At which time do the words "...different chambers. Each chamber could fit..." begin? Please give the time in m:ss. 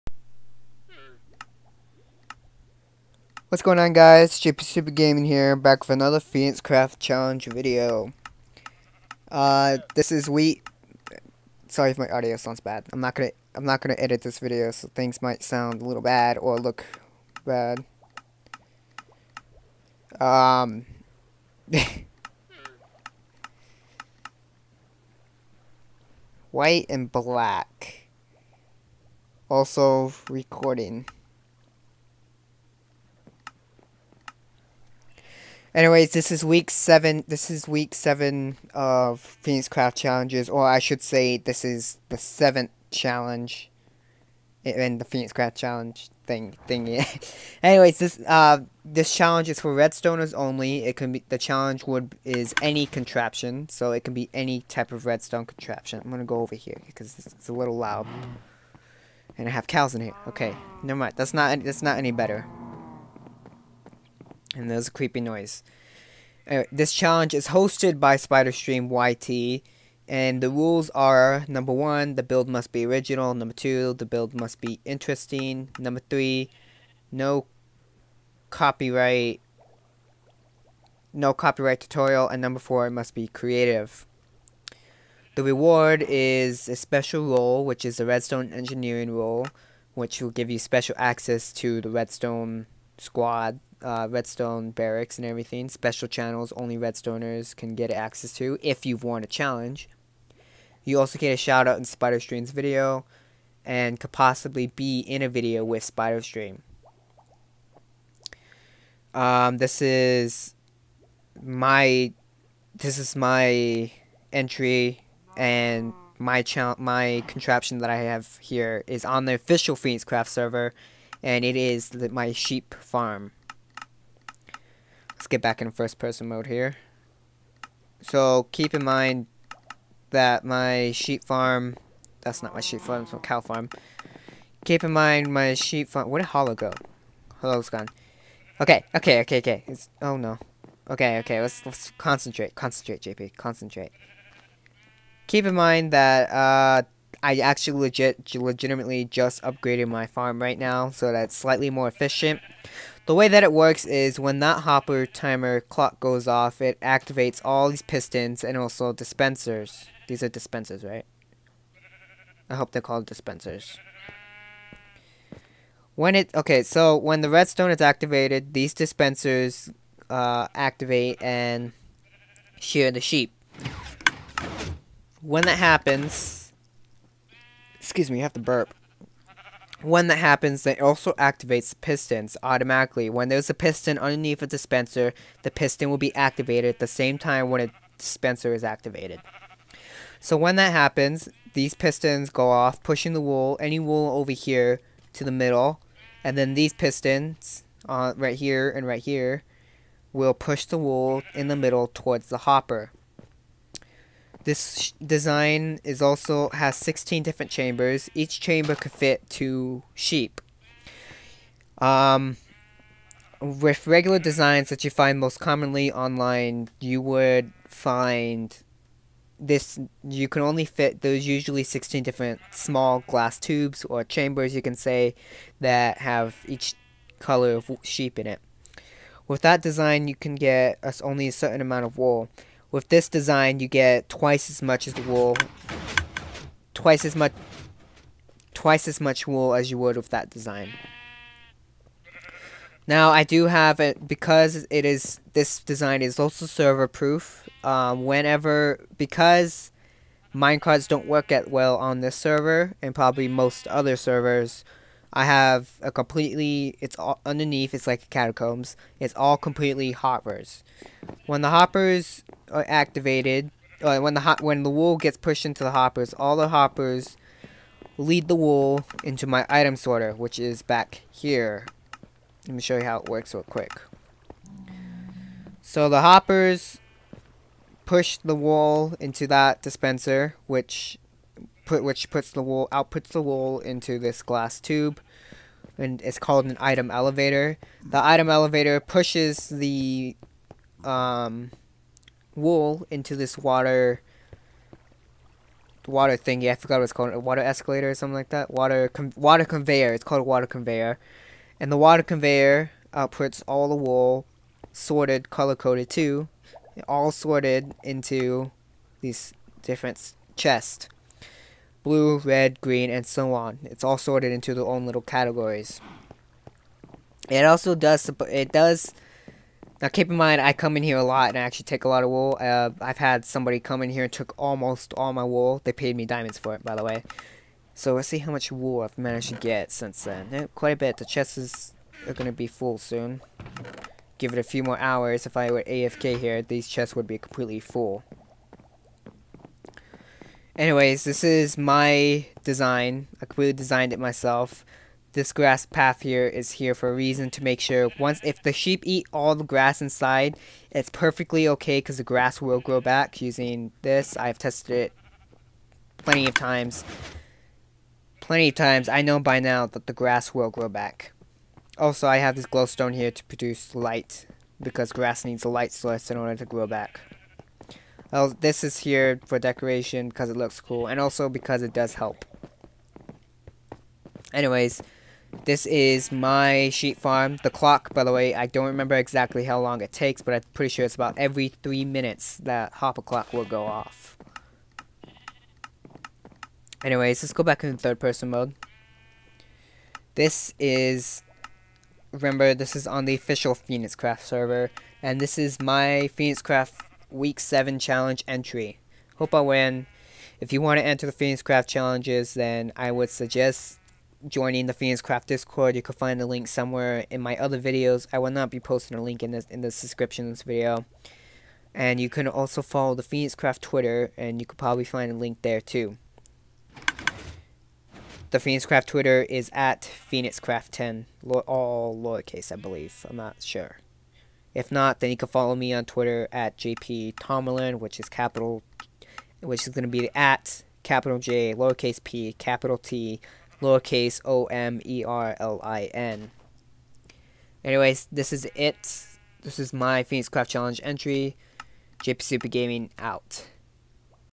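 3:27.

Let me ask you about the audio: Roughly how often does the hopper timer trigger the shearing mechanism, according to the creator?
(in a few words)
every 3 minutes.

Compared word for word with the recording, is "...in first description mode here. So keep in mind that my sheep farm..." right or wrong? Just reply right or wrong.
wrong.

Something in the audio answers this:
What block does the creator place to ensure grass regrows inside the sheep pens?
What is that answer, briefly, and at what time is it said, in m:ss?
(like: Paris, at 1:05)
grass path, at 5:45.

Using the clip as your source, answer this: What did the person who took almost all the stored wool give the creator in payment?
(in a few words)
diamonds.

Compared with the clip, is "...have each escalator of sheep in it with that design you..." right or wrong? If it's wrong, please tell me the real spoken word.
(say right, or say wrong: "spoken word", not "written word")
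wrong: "color", not "escalator".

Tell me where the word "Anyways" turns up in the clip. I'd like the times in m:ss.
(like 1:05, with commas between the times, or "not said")
0:35, 0:47, 1:06, 5:40, 6:14, 6:26, 7:17.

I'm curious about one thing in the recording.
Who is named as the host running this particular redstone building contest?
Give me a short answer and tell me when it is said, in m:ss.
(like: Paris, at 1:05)
SpyderStreem YT, at 1:08.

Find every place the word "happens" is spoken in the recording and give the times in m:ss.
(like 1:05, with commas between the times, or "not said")
2:55, 3:00, 3:10.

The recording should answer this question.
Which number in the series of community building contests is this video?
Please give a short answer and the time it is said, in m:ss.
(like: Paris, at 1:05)
seventh, at 0:42.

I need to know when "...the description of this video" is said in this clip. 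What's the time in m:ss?
6:49.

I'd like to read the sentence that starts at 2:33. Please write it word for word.
The way that it works is when that hopper timer clock goes off, it activates all these pistons and also dispensers.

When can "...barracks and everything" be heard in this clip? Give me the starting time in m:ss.
1:34.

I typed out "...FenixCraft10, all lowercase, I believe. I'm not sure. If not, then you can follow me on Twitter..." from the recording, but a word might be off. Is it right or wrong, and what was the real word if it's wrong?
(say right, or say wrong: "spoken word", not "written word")
right.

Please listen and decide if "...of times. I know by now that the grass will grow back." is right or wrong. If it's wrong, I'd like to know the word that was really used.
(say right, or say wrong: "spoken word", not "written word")
right.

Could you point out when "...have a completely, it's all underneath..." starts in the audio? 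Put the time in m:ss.
4:15.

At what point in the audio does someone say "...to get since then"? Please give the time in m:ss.
5:29.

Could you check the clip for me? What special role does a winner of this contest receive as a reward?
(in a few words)
redstone engineering role.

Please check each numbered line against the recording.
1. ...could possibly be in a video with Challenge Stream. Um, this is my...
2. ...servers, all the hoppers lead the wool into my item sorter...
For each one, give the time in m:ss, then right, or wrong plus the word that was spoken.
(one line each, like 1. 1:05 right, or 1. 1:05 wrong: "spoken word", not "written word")
1. 1:43 wrong: "Spider", not "Challenge"
2. 4:25 wrong: "hoppers", not "servers".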